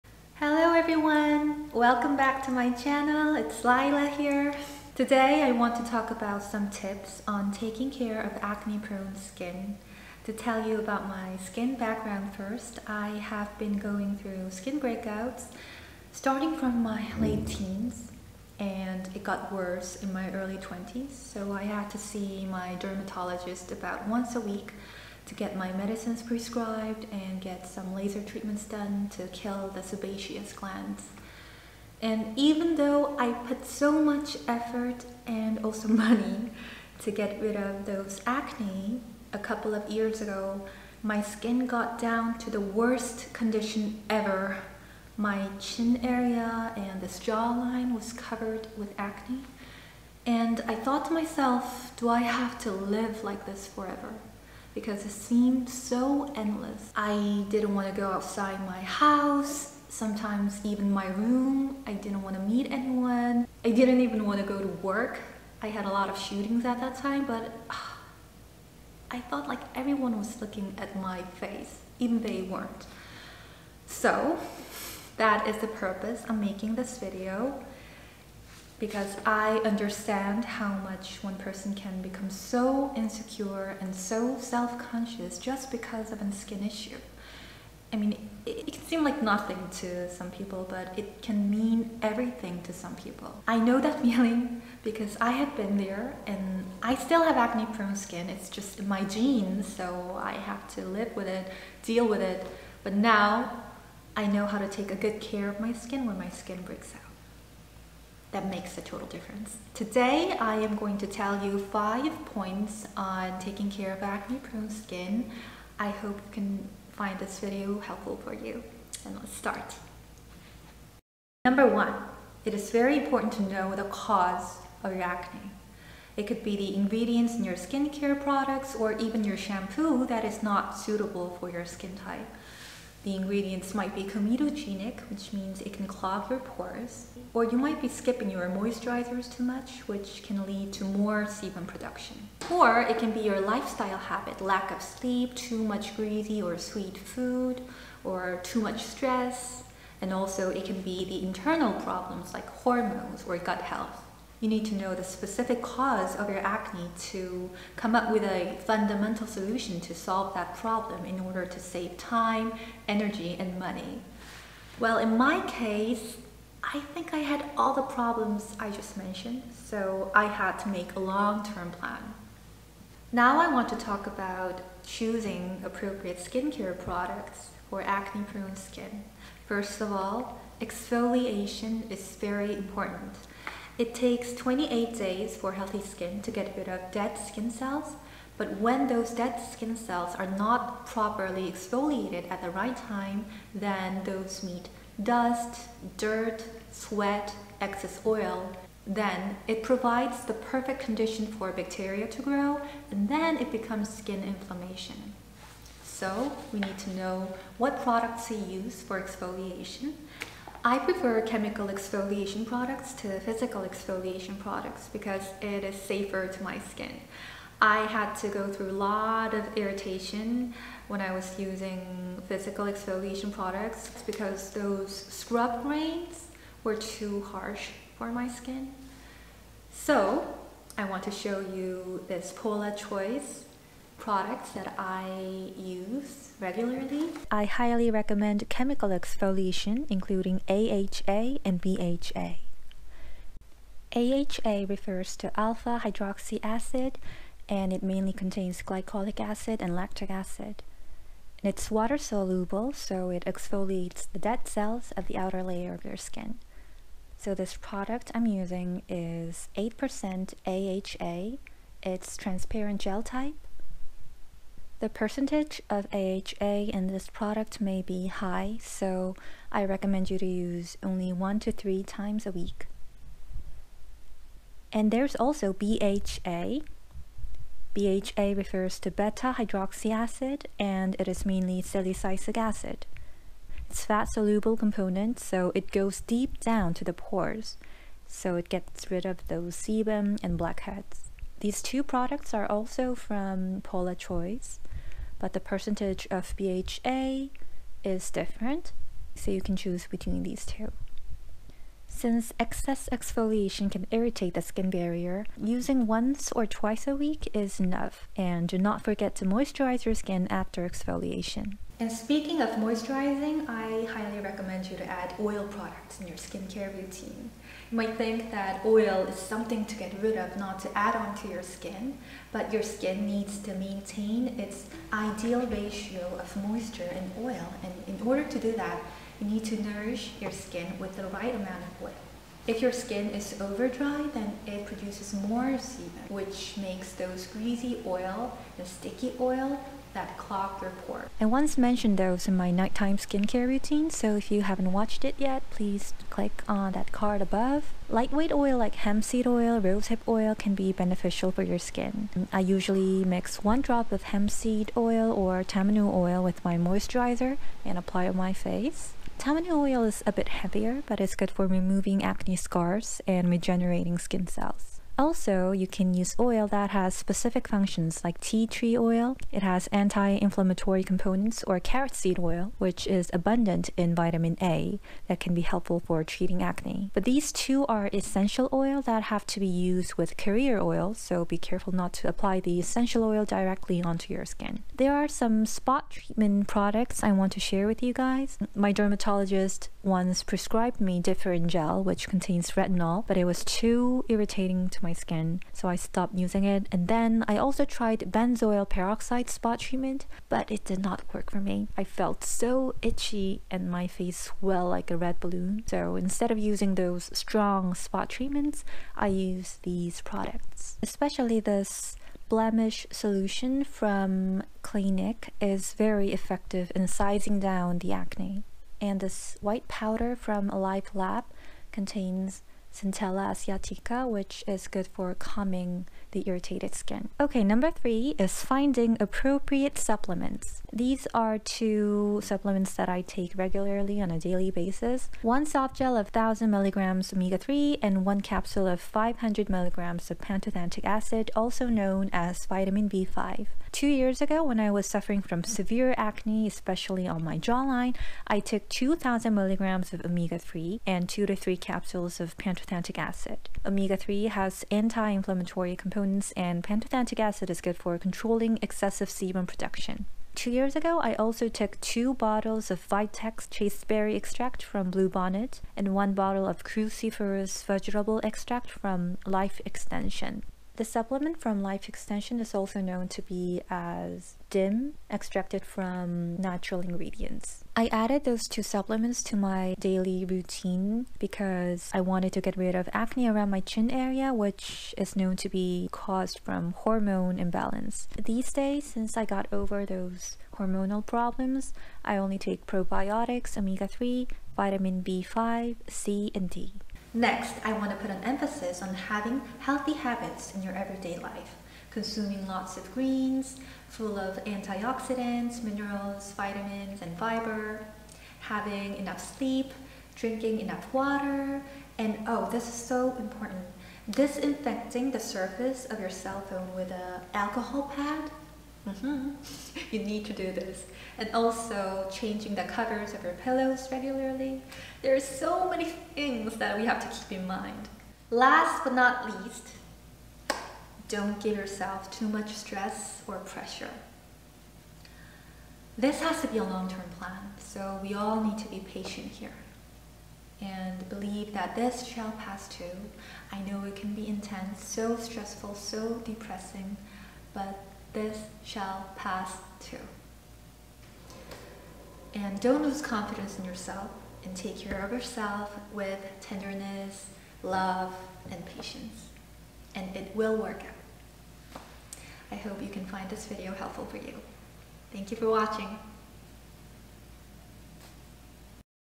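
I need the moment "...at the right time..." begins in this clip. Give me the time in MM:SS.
03:12.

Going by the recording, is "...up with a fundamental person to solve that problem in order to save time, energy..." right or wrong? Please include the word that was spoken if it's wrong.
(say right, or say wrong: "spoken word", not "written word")
wrong: "solution", not "person".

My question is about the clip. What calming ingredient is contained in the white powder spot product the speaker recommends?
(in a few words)
Centella asiatica.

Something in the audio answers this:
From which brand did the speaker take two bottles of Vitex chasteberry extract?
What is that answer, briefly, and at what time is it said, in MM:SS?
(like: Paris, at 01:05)
Bluebonnet, at 07:44.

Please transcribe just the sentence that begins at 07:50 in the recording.
The supplement from Life Extension is also known to be as DIM, extracted from natural ingredients.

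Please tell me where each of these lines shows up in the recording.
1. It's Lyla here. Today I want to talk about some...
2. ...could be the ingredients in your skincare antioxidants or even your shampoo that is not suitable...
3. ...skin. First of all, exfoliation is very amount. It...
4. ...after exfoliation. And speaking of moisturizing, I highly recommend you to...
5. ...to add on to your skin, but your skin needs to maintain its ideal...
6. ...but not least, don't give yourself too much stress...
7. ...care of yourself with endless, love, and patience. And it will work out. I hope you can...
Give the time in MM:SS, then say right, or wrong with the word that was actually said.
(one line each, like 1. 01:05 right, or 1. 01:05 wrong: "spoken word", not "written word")
1. 00:03 right
2. 02:06 wrong: "products", not "antioxidants"
3. 02:58 wrong: "important", not "amount"
4. 05:10 right
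5. 05:20 right
6. 08:48 right
7. 09:14 wrong: "tenderness", not "endless".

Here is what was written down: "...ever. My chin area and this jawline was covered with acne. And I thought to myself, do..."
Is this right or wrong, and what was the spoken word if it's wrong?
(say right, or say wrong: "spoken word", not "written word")
right.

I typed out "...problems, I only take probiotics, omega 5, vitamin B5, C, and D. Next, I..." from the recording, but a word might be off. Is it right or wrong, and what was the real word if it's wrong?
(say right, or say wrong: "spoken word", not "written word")
wrong: "3", not "5".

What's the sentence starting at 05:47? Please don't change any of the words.
Lightweight oil like hemp seed oil, rosehip oil can be beneficial for your skin.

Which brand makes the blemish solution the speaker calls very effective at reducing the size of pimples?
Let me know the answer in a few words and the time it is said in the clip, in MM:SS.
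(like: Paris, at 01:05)
Clinique, at 06:54.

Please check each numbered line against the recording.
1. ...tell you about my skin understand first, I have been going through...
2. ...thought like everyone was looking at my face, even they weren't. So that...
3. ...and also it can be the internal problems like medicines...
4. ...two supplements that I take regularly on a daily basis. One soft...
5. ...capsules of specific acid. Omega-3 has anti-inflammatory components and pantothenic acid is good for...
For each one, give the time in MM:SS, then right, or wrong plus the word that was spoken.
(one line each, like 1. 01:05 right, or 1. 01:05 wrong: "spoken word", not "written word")
1. 00:10 wrong: "background", not "understand"
2. 01:09 right
3. 02:29 wrong: "hormones", not "medicines"
4. 07:11 right
5. 07:31 wrong: "pantothenic", not "specific".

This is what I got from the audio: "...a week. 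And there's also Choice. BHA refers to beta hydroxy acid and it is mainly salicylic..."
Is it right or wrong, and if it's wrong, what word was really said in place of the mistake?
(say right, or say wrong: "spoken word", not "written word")
wrong: "BHA", not "Choice".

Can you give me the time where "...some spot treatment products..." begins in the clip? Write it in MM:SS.
06:25.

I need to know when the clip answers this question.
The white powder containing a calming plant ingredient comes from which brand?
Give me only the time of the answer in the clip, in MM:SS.
07:00.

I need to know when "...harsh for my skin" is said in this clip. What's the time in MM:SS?
03:47.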